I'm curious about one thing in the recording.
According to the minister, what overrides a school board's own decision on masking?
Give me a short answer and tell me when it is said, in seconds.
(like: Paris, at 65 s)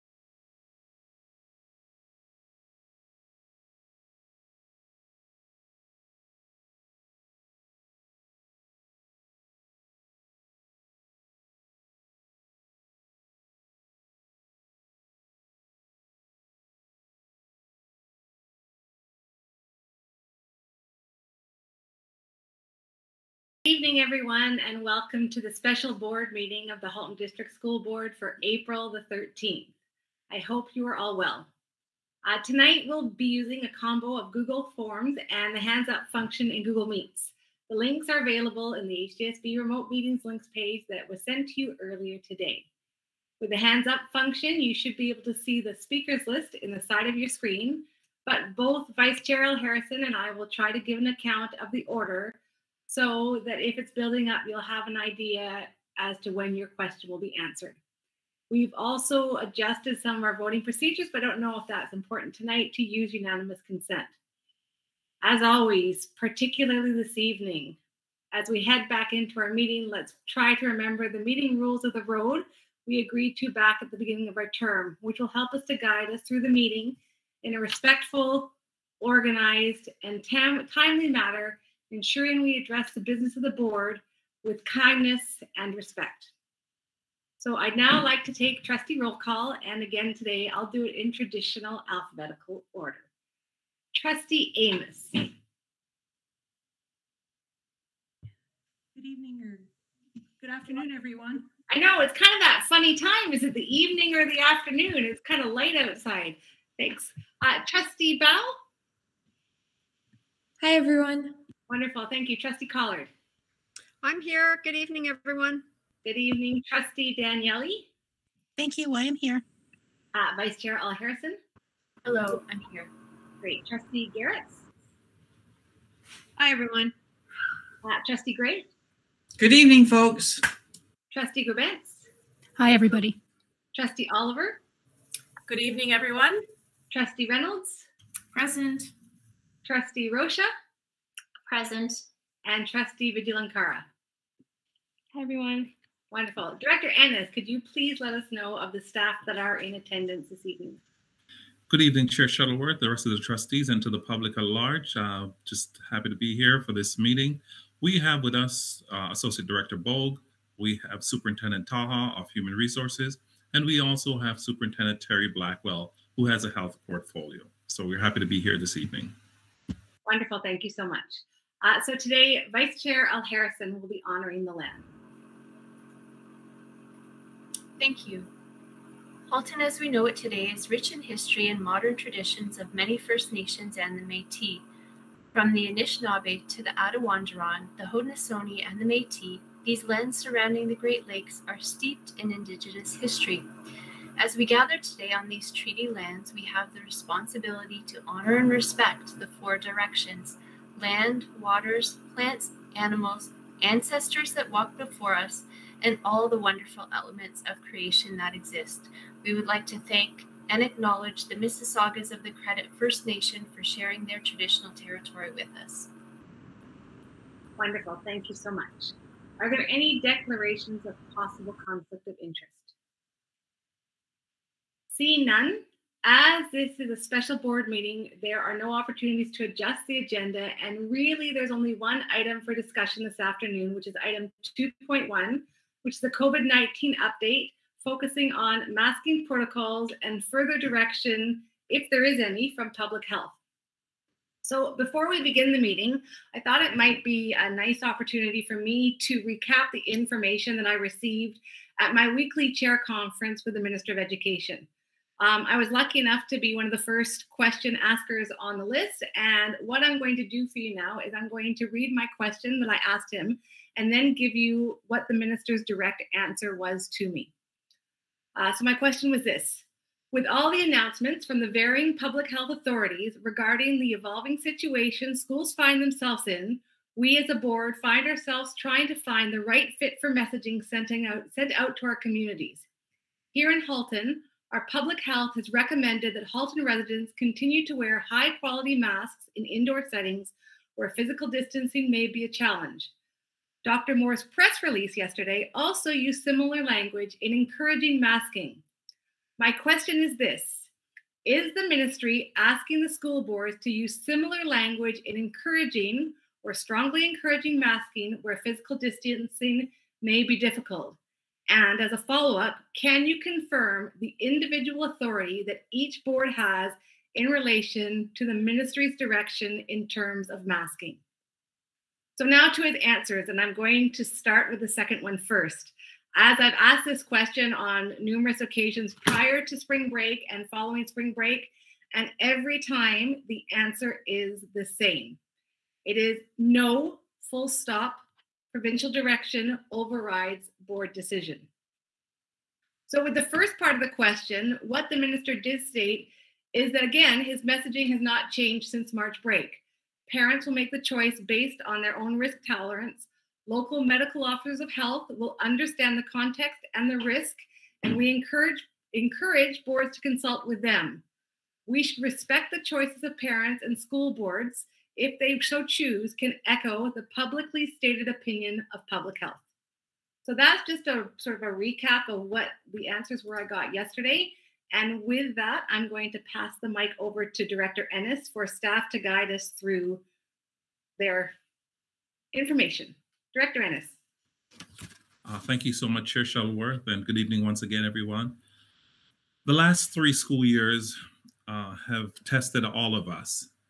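Provincial direction, at 338 s.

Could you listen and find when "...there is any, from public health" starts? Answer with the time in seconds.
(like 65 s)
241 s.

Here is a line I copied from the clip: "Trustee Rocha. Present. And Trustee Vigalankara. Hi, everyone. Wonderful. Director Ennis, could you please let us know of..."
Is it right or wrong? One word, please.
right.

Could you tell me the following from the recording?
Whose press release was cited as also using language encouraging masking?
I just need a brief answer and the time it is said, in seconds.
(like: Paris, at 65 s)
Dr. Moore, at 293 s.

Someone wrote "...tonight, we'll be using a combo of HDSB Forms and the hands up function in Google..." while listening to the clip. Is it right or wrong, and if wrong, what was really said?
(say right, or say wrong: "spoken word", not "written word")
wrong: "Google", not "HDSB".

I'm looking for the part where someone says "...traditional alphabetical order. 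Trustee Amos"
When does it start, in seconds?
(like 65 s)
91 s.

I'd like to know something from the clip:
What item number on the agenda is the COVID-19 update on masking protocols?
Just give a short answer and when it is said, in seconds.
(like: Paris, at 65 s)
2.1, at 234 s.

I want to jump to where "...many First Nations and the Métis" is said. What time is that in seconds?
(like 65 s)
182 s.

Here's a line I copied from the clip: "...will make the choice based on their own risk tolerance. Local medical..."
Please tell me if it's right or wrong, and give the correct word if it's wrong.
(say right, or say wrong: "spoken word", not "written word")
right.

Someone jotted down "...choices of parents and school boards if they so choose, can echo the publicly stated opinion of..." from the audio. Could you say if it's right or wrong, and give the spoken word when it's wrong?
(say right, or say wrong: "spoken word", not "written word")
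right.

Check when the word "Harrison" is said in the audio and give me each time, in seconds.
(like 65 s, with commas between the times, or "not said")
49 s, 120 s, 173 s.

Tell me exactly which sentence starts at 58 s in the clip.
We've also adjusted some of our voting procedures, but I don't know if that's important tonight to use unanimous consent.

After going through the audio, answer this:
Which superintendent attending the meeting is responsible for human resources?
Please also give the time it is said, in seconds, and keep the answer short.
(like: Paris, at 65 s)
Superintendent Taha, at 161 s.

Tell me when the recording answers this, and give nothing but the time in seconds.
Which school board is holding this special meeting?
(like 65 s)
26 s.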